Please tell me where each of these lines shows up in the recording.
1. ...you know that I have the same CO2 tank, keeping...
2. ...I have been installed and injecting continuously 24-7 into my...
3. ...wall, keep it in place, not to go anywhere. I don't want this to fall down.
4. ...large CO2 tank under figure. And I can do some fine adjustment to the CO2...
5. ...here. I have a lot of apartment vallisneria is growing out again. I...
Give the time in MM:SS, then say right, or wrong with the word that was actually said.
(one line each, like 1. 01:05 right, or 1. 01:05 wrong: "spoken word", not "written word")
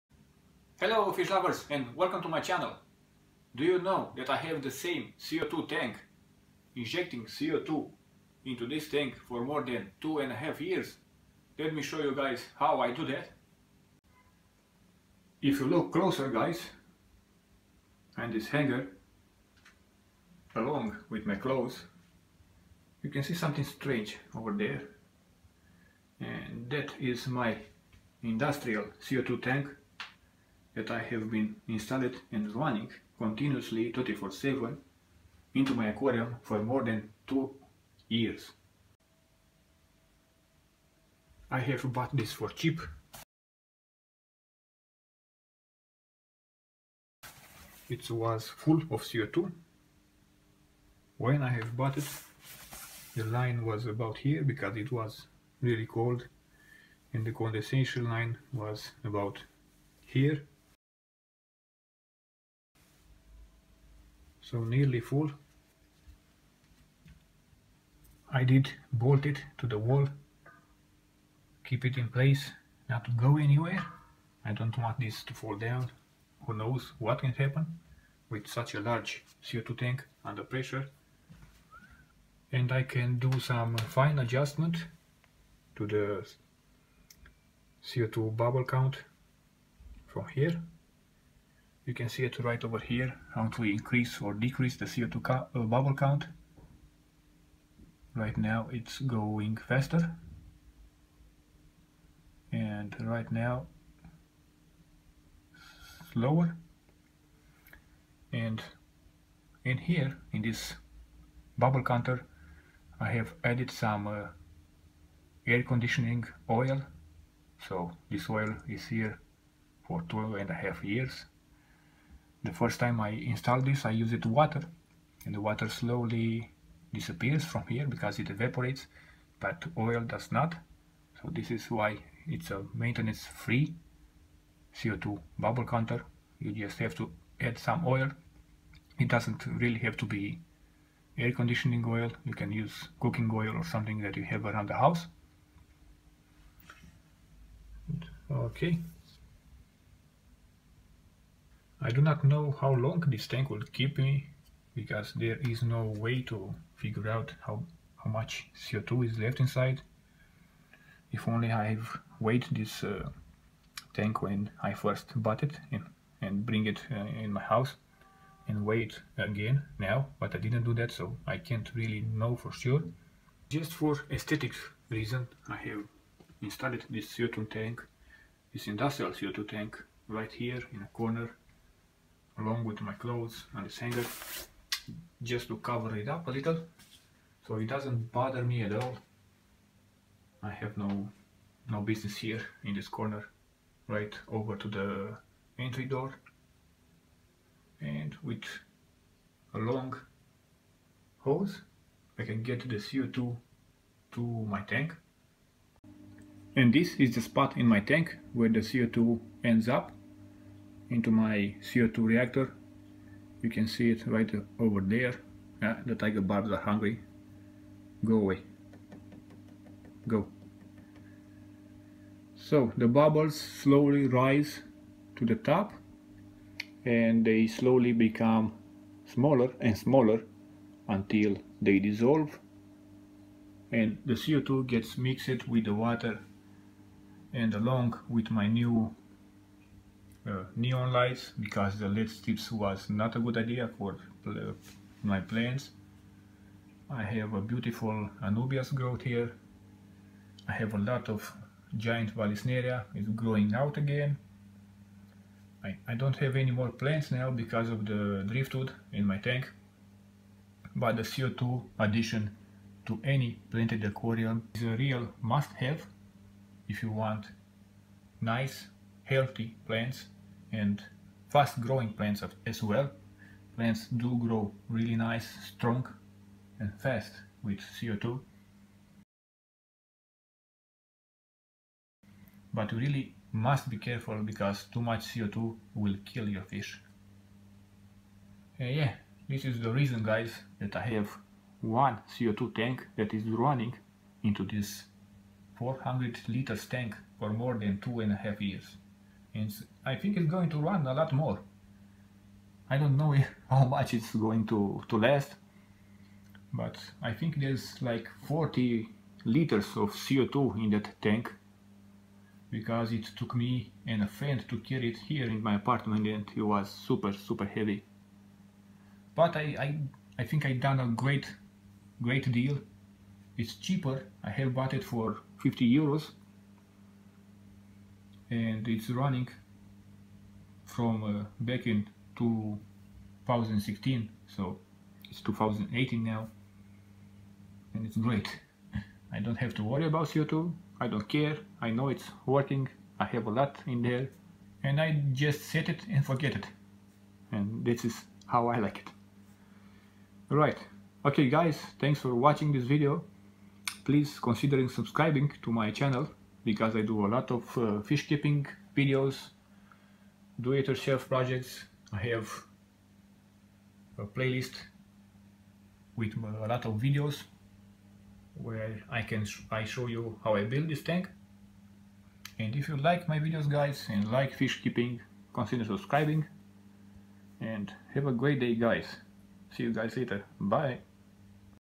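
1. 00:03 wrong: "injecting", not "keeping"
2. 00:30 wrong: "running", not "injecting"
3. 01:09 right
4. 01:18 wrong: "pressure", not "figure"
5. 04:09 wrong: "giant", not "apartment".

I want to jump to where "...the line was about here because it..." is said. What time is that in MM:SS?
00:53.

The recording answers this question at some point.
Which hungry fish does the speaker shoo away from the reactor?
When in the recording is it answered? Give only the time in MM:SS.
03:35.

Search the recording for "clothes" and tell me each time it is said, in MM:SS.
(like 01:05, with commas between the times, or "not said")
00:21, 03:02.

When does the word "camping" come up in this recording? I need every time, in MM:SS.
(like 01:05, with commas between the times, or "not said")
not said.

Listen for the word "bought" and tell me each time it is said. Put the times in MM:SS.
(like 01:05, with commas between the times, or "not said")
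00:41, 00:51, 02:45, 05:24.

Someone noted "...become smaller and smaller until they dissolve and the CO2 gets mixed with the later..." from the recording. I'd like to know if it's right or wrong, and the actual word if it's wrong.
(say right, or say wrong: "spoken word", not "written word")
wrong: "water", not "later".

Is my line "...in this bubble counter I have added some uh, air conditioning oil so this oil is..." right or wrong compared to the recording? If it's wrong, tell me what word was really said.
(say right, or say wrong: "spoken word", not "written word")
right.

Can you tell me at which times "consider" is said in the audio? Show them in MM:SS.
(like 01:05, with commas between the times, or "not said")
05:54, 06:15.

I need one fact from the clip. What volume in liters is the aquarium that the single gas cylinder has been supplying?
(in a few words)
400 liters.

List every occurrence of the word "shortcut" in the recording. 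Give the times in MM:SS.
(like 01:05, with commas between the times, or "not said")
not said.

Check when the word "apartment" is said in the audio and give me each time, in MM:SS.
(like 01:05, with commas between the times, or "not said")
05:15.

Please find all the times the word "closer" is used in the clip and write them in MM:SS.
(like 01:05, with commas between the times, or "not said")
00:15.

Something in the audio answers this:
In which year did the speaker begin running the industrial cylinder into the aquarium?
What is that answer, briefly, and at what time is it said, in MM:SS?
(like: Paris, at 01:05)
2016, at 05:32.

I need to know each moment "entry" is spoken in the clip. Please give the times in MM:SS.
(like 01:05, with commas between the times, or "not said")
03:15.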